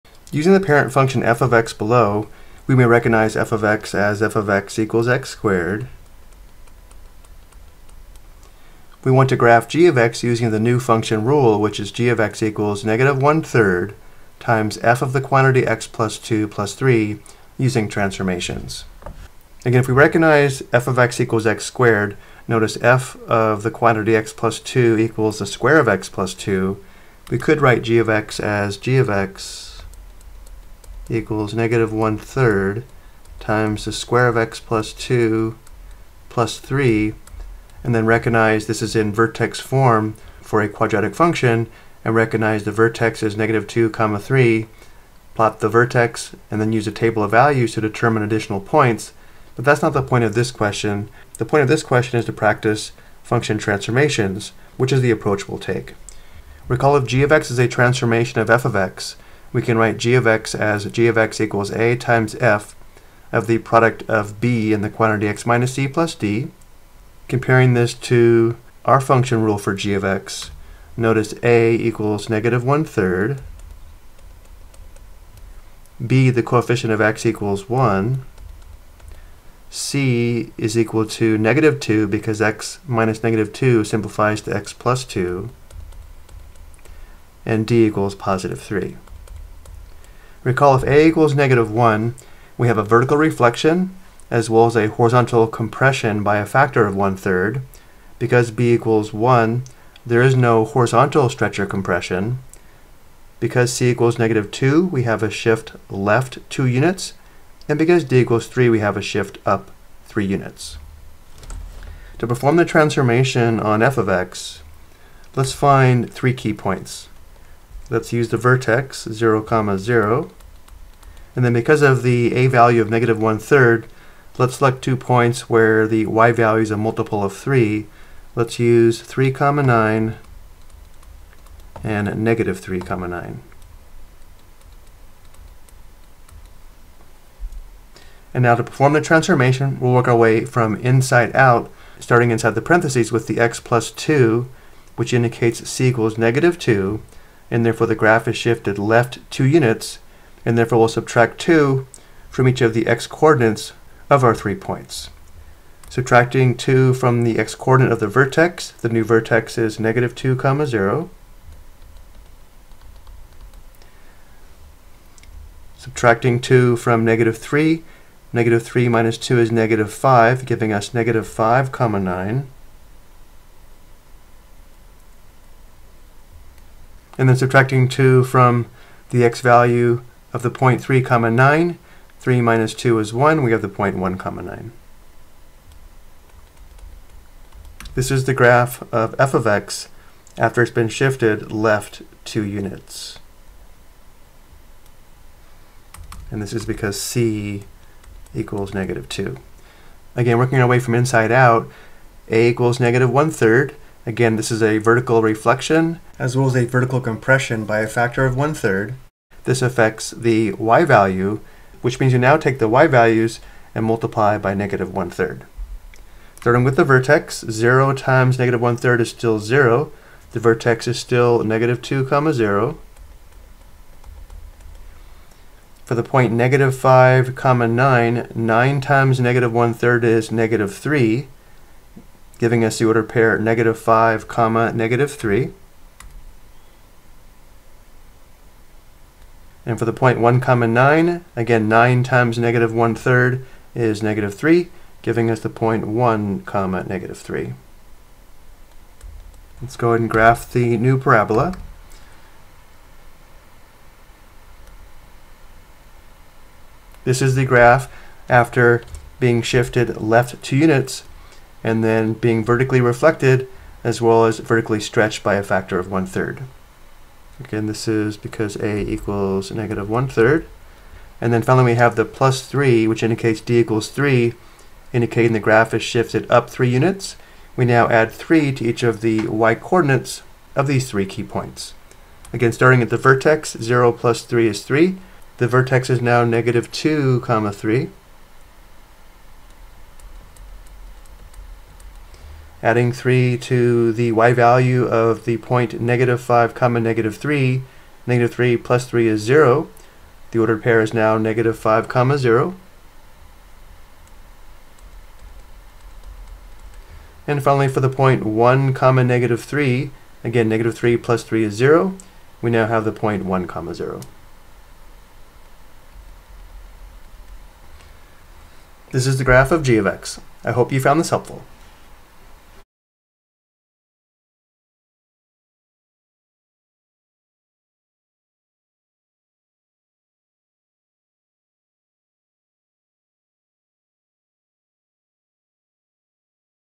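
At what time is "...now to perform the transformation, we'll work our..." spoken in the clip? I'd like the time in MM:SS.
02:18.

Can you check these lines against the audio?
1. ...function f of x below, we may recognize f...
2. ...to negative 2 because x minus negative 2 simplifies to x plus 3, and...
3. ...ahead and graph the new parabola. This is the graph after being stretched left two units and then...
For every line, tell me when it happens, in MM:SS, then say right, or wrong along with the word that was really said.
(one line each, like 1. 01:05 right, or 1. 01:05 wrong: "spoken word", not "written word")
1. 00:00 right
2. 01:21 wrong: "2", not "3"
3. 04:09 wrong: "shifted", not "stretched".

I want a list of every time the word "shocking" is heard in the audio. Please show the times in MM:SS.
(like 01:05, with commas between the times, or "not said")
not said.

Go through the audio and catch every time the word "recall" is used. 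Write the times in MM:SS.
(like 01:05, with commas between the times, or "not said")
00:56, 01:30.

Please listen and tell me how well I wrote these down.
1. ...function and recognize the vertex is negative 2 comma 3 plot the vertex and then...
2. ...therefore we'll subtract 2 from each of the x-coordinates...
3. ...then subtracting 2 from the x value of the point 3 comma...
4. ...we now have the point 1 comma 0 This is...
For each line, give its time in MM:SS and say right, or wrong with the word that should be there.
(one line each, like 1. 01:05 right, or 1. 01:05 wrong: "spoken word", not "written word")
1. 00:41 right
2. 02:30 right
3. 02:57 right
4. 05:12 right.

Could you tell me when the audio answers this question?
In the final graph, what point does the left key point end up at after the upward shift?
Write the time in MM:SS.
05:01.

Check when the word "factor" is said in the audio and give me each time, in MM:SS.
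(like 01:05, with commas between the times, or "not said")
01:36, 03:27, 04:25.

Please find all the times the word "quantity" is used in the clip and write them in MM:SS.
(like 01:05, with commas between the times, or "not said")
00:15, 00:23, 01:04.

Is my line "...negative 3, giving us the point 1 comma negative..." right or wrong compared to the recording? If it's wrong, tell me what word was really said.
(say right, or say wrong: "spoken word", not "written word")
right.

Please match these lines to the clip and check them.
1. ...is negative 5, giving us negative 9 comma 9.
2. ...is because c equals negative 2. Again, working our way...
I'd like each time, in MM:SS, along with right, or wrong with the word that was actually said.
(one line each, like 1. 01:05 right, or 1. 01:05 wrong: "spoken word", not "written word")
1. 02:49 wrong: "5", not "9"
2. 03:16 right.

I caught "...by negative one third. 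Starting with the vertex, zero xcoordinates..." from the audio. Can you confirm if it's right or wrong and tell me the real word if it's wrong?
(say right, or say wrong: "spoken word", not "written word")
wrong: "times", not "xcoordinates".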